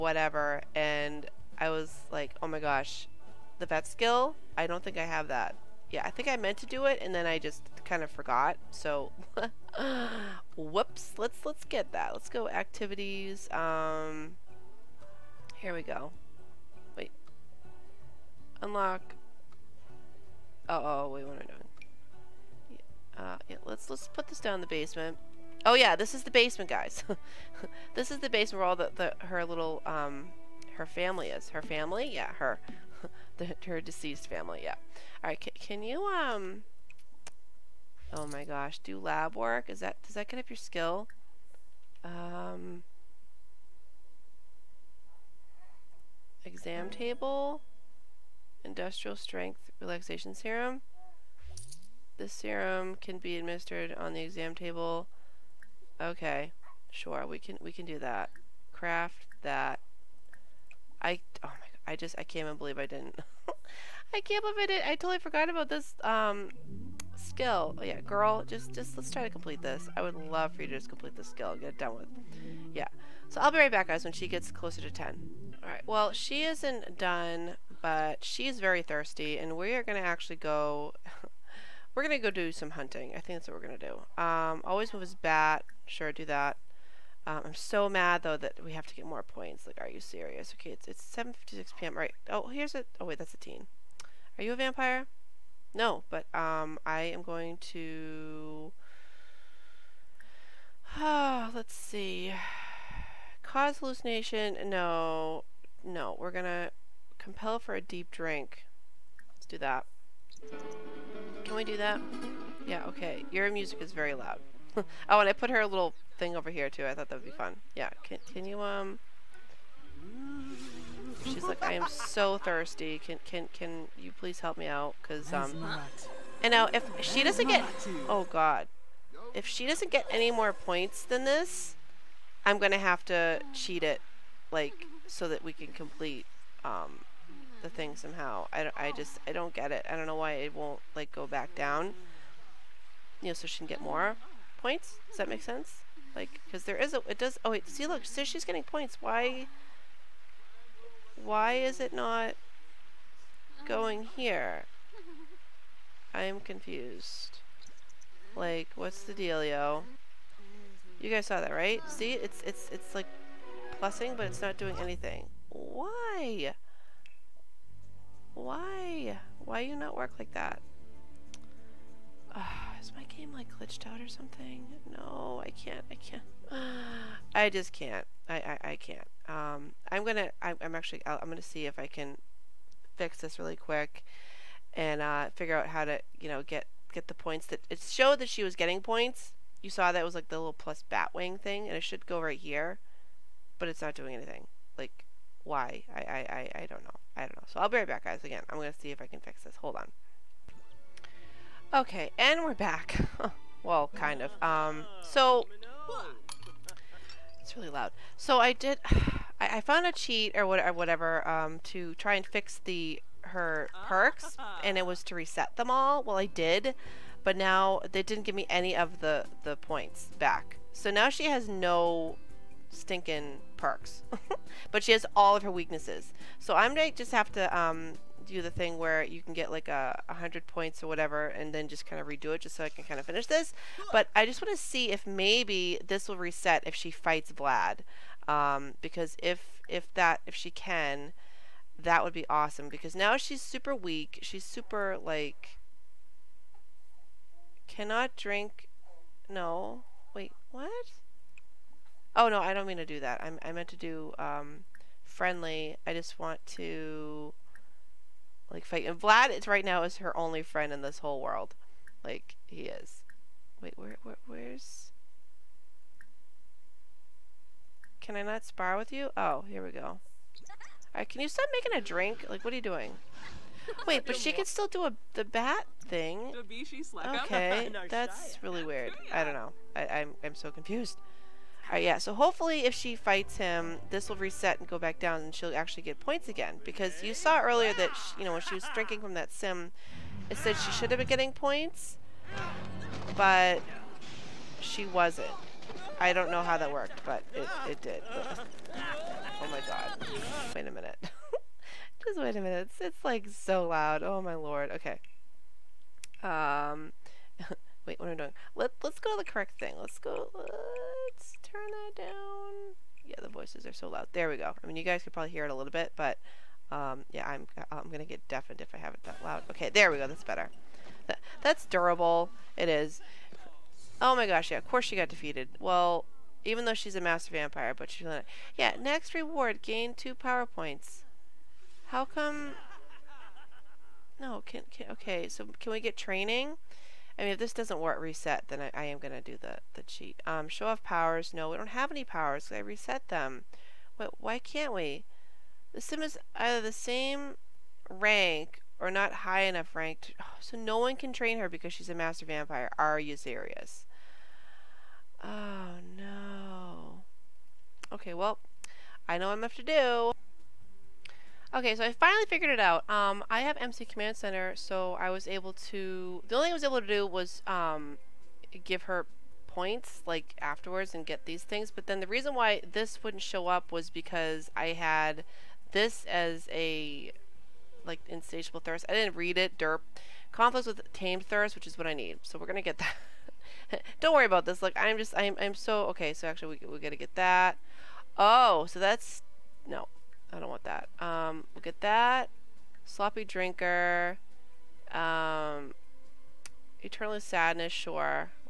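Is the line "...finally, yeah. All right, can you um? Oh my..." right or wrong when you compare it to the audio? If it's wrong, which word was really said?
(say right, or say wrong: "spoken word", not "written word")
wrong: "family", not "finally".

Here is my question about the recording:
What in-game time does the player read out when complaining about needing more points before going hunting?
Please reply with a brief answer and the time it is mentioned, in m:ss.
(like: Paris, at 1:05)
7:56 p.m., at 1:31.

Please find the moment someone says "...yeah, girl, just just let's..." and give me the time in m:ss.
1:07.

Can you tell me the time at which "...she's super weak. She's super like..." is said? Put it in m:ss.
4:03.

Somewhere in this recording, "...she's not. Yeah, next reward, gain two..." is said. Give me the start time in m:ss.
5:27.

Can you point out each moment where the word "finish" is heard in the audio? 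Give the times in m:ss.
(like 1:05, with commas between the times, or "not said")
3:53.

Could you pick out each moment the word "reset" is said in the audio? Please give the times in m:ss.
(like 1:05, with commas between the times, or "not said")
3:35, 3:56, 4:44, 5:38, 5:42.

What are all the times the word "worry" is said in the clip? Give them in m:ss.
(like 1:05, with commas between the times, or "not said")
6:24.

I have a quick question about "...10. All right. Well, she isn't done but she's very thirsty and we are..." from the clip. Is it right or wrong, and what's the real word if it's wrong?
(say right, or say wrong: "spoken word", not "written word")
right.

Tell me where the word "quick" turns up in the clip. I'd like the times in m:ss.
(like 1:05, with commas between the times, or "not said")
3:03.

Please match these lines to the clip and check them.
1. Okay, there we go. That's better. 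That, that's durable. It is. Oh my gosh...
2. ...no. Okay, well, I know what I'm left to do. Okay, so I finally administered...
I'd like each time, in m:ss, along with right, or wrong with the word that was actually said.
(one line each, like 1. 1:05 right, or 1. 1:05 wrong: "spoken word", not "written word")
1. 5:19 right
2. 5:55 wrong: "figured", not "administered".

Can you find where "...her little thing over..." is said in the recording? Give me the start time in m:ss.
1:55.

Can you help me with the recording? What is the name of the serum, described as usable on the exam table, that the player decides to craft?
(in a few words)
Industrial Strength Relaxation Serum.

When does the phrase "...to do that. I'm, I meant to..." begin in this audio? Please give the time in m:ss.
4:12.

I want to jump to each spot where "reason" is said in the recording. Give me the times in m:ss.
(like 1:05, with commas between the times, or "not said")
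6:12.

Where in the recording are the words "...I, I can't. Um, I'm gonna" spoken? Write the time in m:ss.
2:58.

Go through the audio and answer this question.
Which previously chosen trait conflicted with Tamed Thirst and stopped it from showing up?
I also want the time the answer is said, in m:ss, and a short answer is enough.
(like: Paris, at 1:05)
Insatiable thirst, at 6:18.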